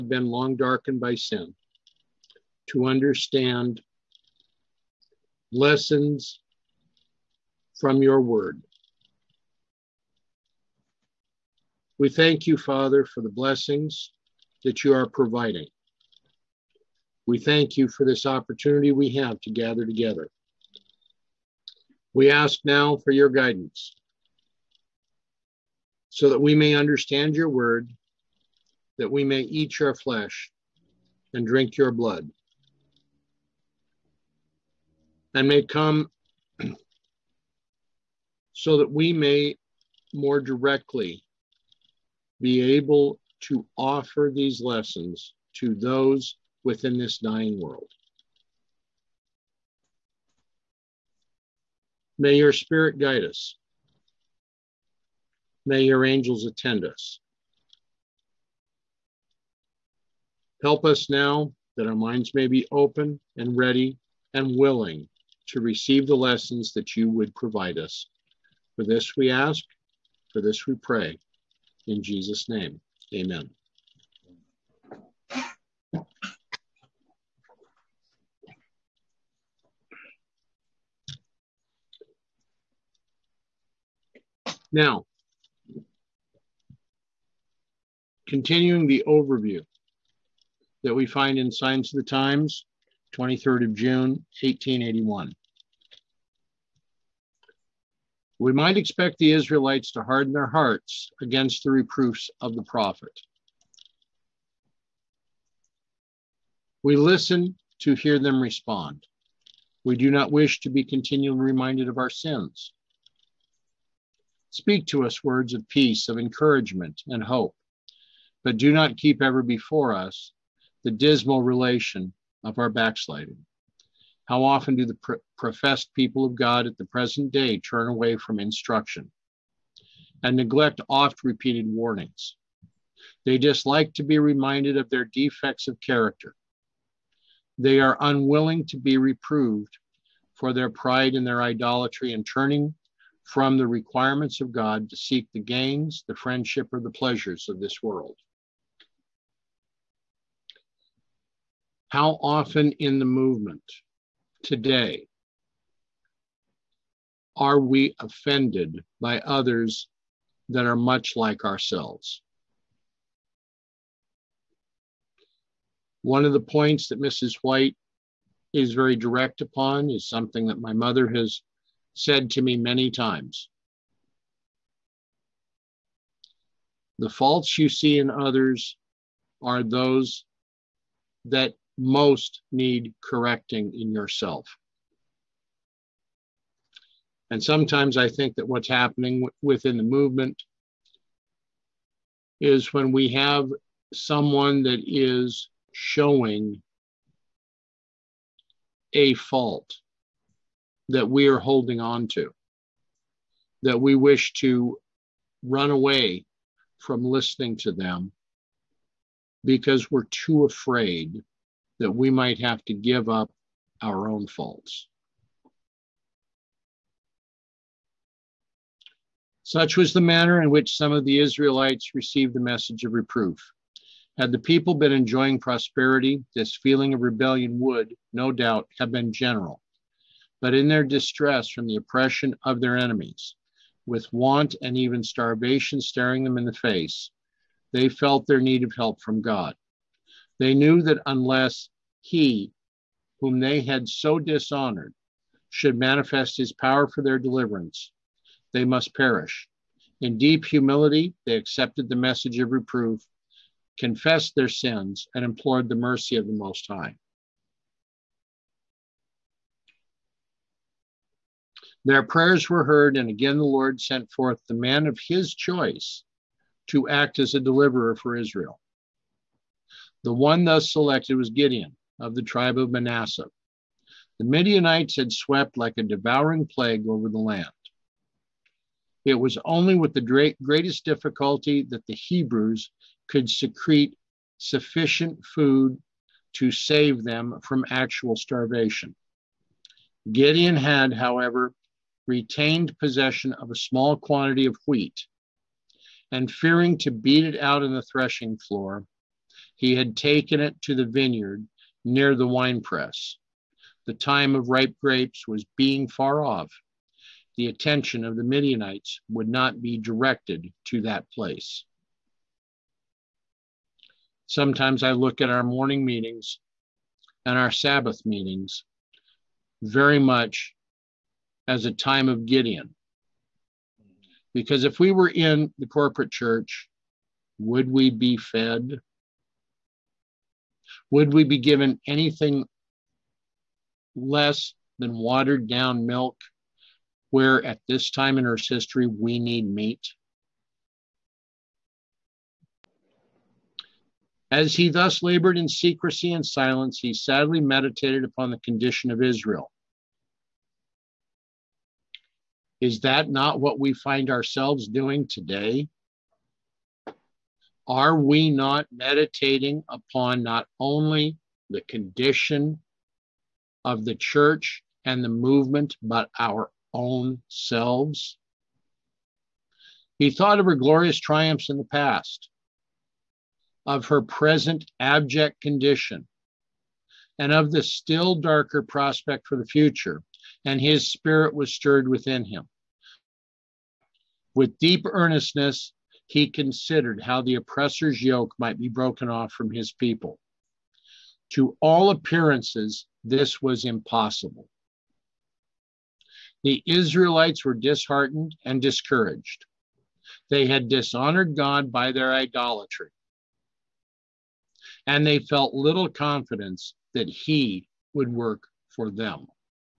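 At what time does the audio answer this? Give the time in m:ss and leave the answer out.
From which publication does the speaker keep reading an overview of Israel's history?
1:31.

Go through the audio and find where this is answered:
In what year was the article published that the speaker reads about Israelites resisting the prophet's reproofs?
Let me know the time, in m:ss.
1:34.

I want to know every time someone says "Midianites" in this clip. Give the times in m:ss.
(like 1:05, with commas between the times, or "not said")
4:34, 5:08.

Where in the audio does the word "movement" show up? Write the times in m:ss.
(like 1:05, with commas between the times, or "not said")
2:33, 3:09, 6:05.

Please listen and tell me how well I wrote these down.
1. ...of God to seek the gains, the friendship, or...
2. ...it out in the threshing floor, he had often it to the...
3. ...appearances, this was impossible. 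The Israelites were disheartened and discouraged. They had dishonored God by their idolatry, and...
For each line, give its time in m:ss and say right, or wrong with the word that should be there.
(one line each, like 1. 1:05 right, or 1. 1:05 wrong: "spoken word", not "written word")
1. 2:24 right
2. 4:57 wrong: "taken", not "often"
3. 6:31 right.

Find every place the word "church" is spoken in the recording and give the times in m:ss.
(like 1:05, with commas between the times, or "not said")
5:26, 6:03.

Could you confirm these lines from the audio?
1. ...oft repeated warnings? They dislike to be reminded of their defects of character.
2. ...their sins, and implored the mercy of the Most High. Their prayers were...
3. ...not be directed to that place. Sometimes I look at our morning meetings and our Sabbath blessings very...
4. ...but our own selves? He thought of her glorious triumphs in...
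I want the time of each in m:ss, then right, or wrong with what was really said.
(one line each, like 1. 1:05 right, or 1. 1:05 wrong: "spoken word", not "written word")
1. 2:10 right
2. 4:14 right
3. 5:09 wrong: "meetings", not "blessings"
4. 6:05 right.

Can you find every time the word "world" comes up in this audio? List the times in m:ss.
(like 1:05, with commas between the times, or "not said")
0:47, 2:27.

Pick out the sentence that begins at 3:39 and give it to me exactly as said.
Such was the manner in which some of the Israelites received the message of reproof.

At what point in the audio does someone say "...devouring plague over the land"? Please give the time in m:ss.
4:35.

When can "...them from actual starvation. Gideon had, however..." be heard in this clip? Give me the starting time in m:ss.
4:47.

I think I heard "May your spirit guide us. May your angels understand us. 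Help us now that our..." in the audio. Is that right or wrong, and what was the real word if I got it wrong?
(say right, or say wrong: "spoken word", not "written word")
wrong: "attend", not "understand".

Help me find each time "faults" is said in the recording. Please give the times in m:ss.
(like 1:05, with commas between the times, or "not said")
2:57, 3:19, 3:34.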